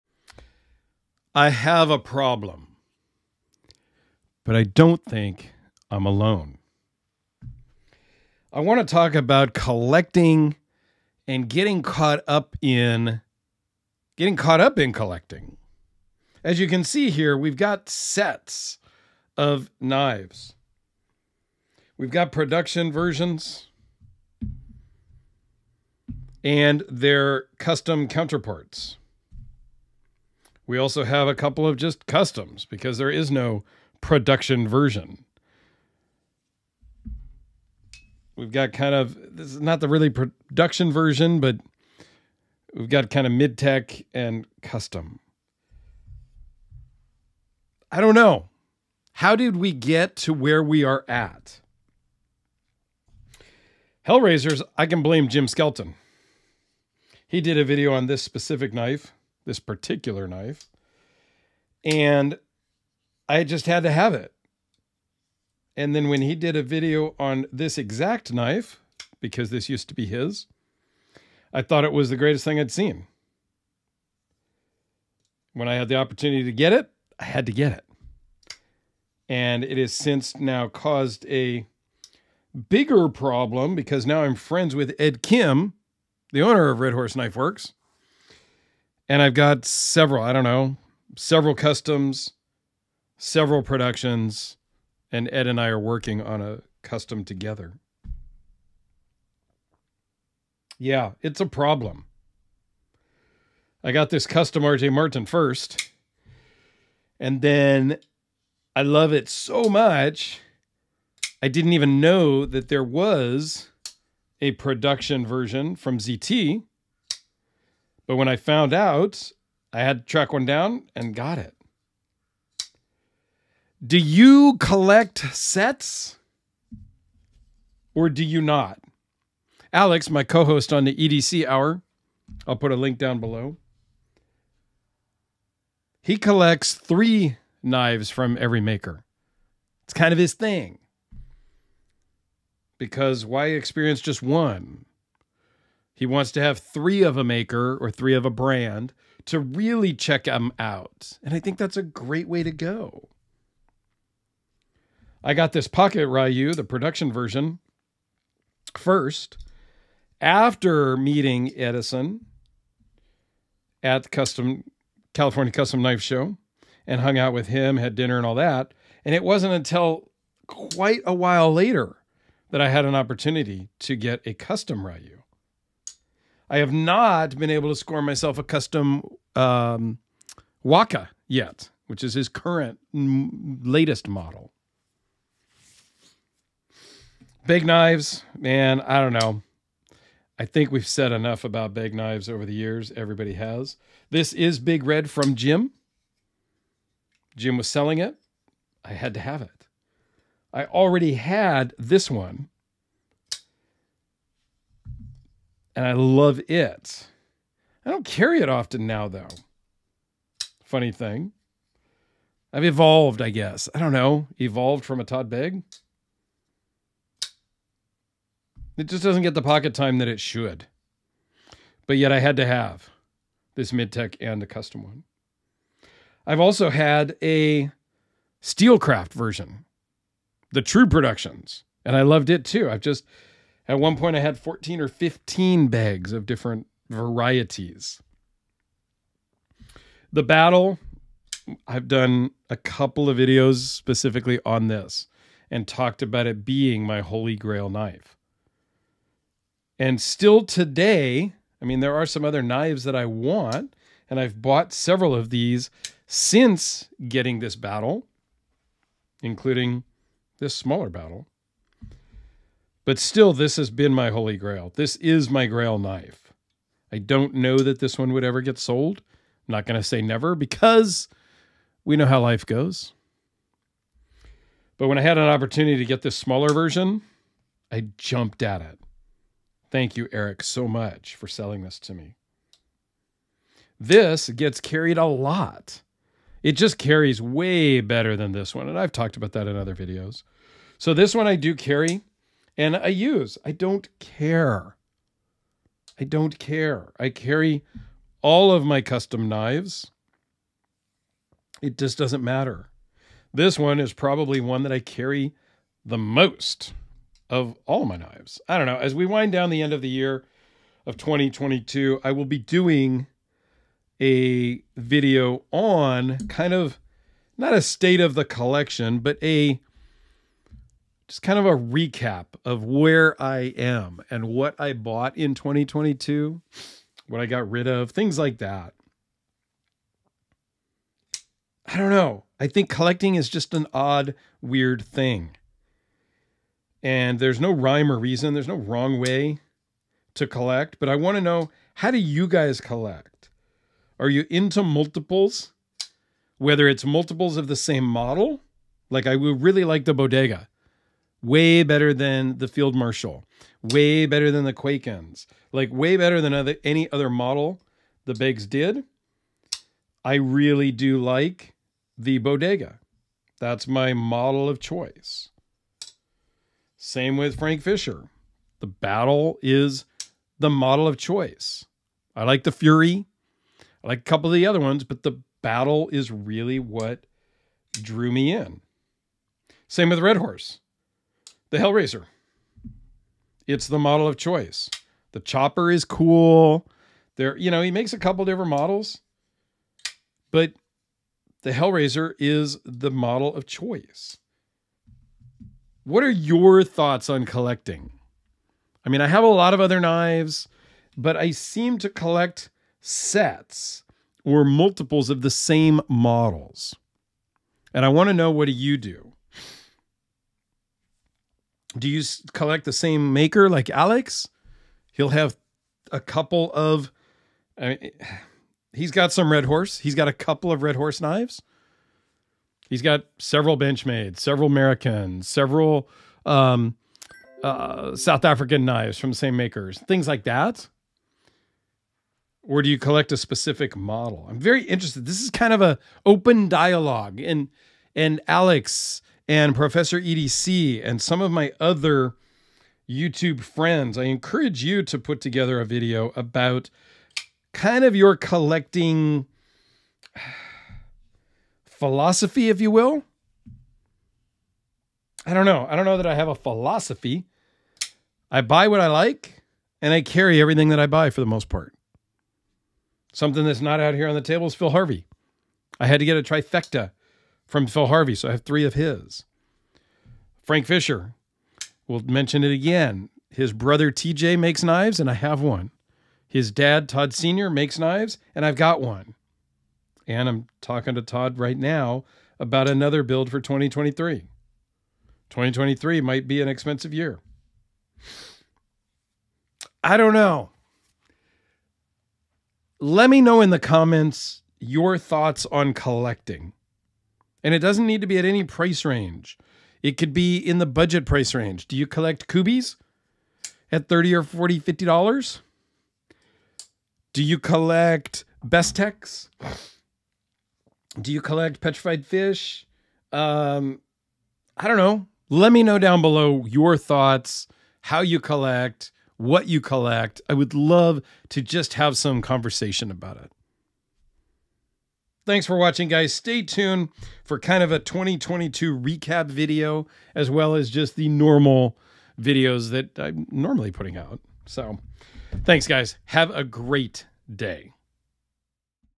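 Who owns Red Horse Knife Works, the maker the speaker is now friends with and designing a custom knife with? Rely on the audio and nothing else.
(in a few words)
Ed Kim.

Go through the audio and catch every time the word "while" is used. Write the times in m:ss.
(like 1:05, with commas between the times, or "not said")
2:51.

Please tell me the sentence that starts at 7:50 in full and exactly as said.
Frank Fisher, we'll mention it again.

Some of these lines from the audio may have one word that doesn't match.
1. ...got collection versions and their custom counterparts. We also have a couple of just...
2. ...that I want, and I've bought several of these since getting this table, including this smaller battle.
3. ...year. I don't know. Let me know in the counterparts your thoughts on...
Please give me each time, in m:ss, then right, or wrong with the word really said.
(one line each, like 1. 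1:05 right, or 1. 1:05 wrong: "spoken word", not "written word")
1. 0:22 wrong: "production", not "collection"
2. 4:12 wrong: "battle", not "table"
3. 8:06 wrong: "comments", not "counterparts".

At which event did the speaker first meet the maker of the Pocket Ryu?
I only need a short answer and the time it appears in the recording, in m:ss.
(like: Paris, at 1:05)
California Custom Knife Show, at 2:45.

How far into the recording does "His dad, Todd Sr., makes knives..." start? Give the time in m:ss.
7:56.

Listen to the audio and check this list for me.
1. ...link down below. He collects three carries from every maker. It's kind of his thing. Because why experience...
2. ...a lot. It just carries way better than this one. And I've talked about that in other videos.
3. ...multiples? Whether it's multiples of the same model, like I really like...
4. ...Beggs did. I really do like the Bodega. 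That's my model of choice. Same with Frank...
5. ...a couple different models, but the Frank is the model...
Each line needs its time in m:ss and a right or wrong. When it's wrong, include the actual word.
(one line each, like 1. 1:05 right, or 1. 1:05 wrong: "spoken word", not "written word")
1. 2:12 wrong: "knives", not "carries"
2. 4:44 right
3. 5:44 right
4. 5:58 right
5. 6:27 wrong: "Hellraiser", not "Frank".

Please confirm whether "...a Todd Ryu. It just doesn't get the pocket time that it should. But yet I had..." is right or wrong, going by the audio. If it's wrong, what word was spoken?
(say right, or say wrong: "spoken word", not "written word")
wrong: "Begg", not "Ryu".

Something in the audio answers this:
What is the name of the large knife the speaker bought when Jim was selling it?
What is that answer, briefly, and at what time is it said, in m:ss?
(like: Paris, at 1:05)
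Big Red, at 3:14.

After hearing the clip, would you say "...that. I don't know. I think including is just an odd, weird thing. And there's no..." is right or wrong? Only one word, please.
wrong.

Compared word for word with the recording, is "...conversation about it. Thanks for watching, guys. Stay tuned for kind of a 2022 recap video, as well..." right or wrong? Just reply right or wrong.
right.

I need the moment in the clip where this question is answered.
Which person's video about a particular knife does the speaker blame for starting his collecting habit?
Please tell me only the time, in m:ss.
0:55.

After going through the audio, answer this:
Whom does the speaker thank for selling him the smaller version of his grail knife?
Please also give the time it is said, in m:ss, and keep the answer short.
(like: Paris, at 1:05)
Eric, at 4:40.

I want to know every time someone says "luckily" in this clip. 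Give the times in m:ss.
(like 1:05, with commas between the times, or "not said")
not said.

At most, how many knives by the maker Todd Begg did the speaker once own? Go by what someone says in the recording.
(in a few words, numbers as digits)
15.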